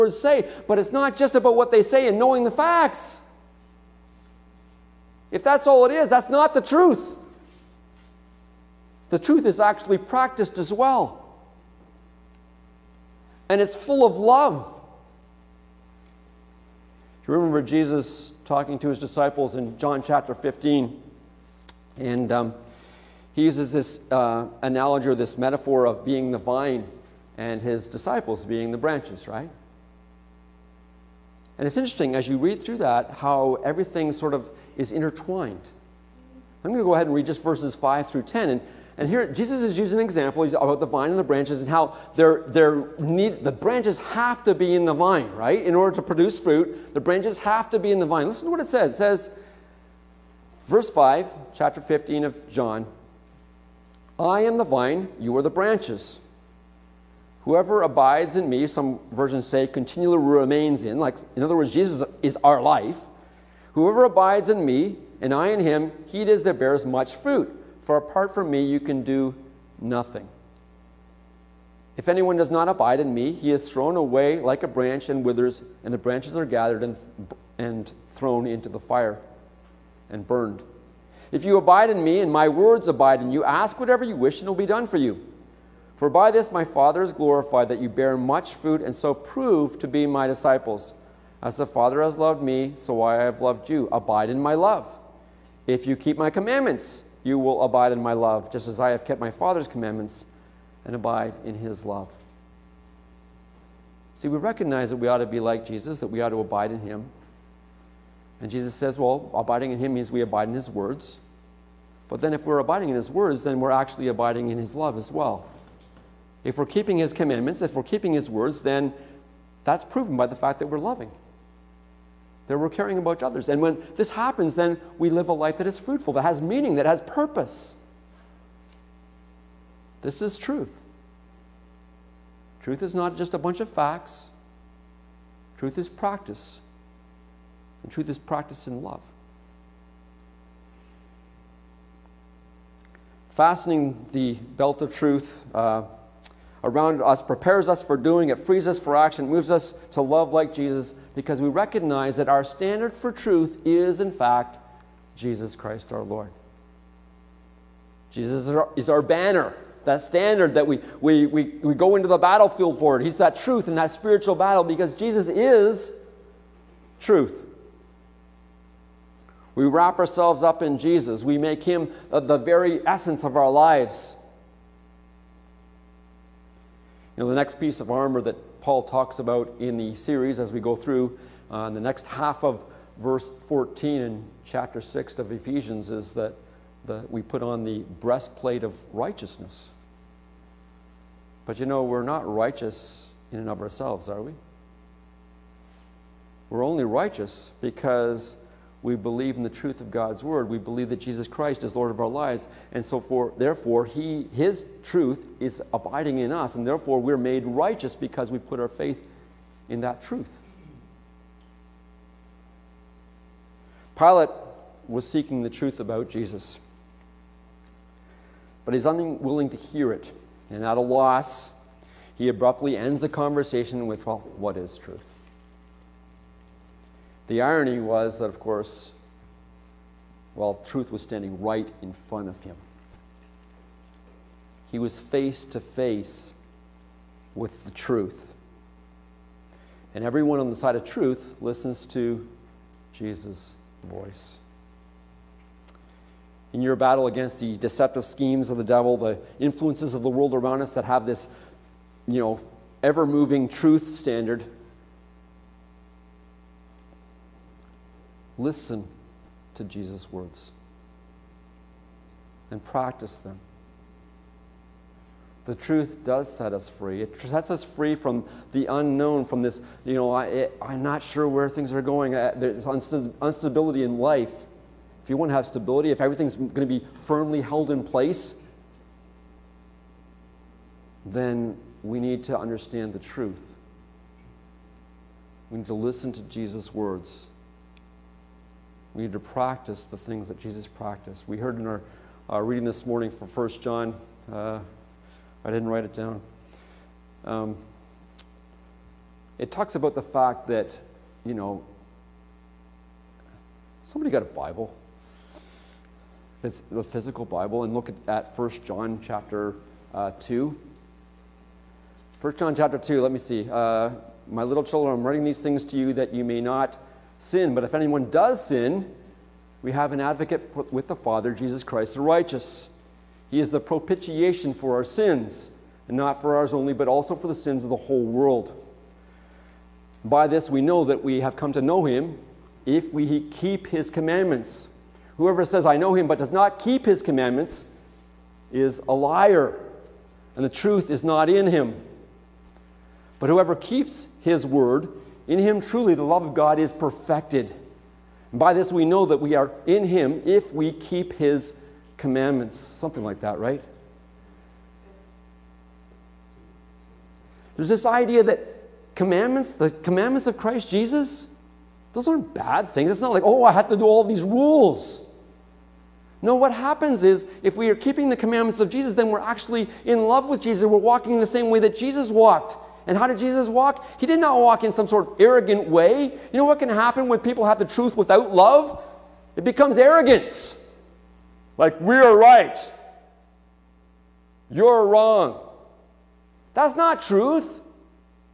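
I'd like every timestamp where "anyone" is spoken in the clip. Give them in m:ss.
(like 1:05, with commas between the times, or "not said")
1:12, 5:17.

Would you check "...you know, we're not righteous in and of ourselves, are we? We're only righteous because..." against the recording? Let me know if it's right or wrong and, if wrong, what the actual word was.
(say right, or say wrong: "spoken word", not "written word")
right.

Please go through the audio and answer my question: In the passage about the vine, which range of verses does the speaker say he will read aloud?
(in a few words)
5 through 10.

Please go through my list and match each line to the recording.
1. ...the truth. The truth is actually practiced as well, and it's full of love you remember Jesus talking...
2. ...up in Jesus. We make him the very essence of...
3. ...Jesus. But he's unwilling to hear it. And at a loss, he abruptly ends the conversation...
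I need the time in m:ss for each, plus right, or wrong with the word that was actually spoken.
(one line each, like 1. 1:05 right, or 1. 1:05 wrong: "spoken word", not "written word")
1. 0:06 right
2. 2:50 right
3. 3:36 right.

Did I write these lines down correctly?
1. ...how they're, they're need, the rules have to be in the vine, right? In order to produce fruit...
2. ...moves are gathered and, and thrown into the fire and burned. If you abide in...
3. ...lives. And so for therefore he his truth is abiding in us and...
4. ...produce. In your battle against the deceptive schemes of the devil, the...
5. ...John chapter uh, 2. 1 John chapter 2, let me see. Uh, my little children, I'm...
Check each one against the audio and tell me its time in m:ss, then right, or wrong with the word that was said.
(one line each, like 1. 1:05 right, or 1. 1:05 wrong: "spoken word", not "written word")
1. 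0:41 wrong: "branches", not "rules"
2. 1:15 wrong: "branches", not "moves"
3. 3:22 right
4. 4:03 wrong: "voice", not "produce"
5. 5:08 right.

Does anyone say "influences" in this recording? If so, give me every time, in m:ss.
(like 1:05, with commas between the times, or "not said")
4:09.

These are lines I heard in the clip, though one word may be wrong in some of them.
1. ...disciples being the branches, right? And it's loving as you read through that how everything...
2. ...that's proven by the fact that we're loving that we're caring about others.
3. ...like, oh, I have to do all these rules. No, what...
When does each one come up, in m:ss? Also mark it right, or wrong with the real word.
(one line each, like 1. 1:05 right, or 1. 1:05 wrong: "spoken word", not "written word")
1. 0:27 wrong: "interesting", not "loving"
2. 1:59 right
3. 6:03 right.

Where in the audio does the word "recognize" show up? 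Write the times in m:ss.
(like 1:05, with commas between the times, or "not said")
1:44, 2:31.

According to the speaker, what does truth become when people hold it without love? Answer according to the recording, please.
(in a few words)
Arrogance.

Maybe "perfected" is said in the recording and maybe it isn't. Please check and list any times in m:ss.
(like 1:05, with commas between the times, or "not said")
5:46.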